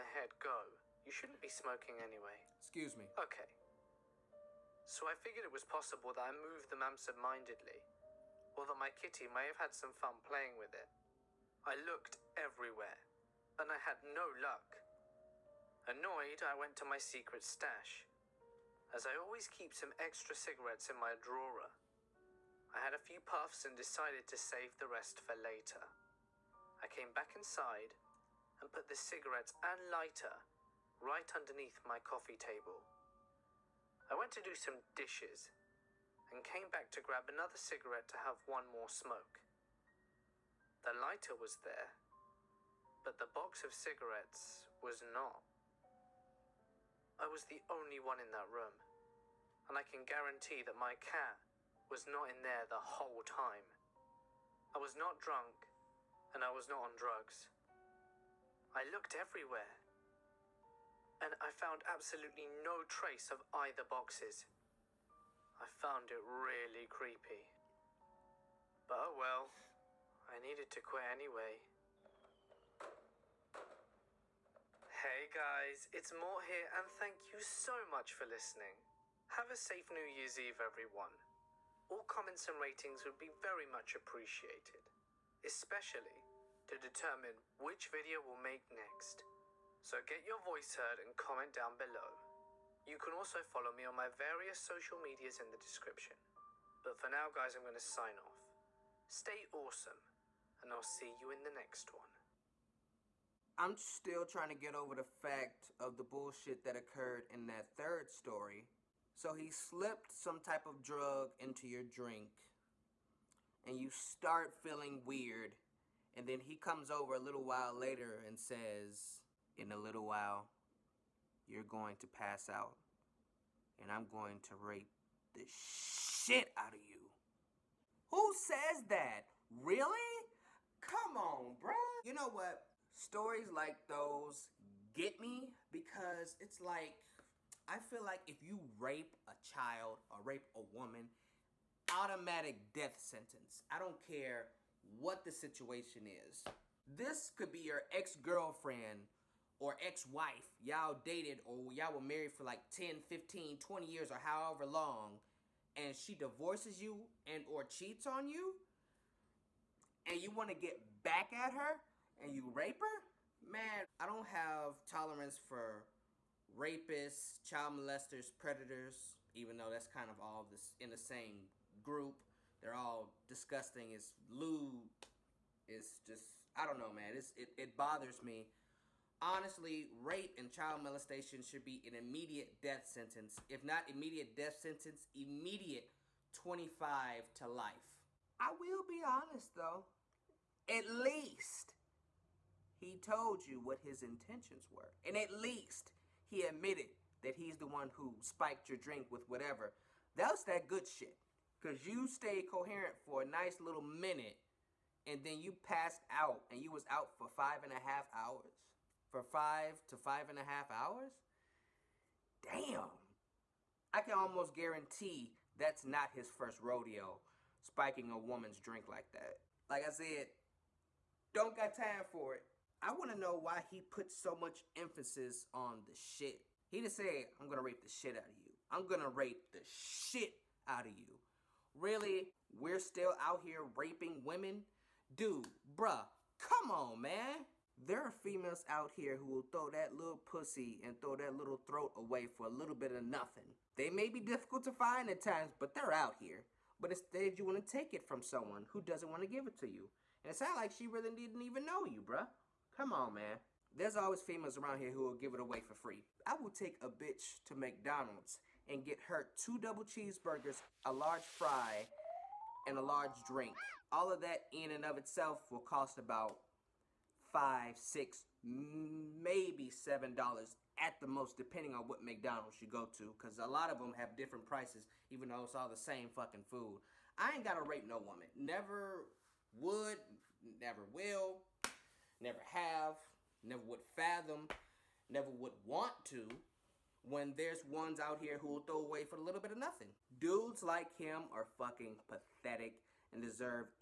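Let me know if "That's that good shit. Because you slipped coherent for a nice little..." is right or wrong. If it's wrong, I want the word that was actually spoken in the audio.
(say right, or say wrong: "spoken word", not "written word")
wrong: "stayed", not "slipped".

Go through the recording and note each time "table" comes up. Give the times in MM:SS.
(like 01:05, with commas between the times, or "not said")
00:32.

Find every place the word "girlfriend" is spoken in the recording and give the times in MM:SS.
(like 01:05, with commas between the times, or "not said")
02:27.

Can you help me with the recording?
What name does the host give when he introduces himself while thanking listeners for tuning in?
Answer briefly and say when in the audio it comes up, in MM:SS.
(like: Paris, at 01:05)
Mort, at 01:16.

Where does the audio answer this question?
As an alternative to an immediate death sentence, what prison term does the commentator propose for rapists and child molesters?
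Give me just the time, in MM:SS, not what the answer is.
03:06.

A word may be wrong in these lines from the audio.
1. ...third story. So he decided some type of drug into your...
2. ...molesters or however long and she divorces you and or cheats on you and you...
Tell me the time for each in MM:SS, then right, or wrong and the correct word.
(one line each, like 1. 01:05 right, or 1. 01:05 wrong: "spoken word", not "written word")
1. 01:47 wrong: "slipped", not "decided"
2. 02:33 wrong: "years", not "molesters".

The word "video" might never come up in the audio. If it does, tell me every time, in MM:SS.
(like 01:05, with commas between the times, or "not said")
01:27.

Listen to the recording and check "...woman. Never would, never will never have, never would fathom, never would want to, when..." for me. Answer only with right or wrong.
right.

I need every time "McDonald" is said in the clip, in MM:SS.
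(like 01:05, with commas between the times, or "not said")
04:17, 04:32.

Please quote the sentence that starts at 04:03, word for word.
They may be difficult to find at times, but they're out here.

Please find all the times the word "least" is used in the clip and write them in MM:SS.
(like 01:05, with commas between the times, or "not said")
03:10, 03:15.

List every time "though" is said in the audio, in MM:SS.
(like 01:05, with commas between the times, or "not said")
02:49, 03:09, 04:35.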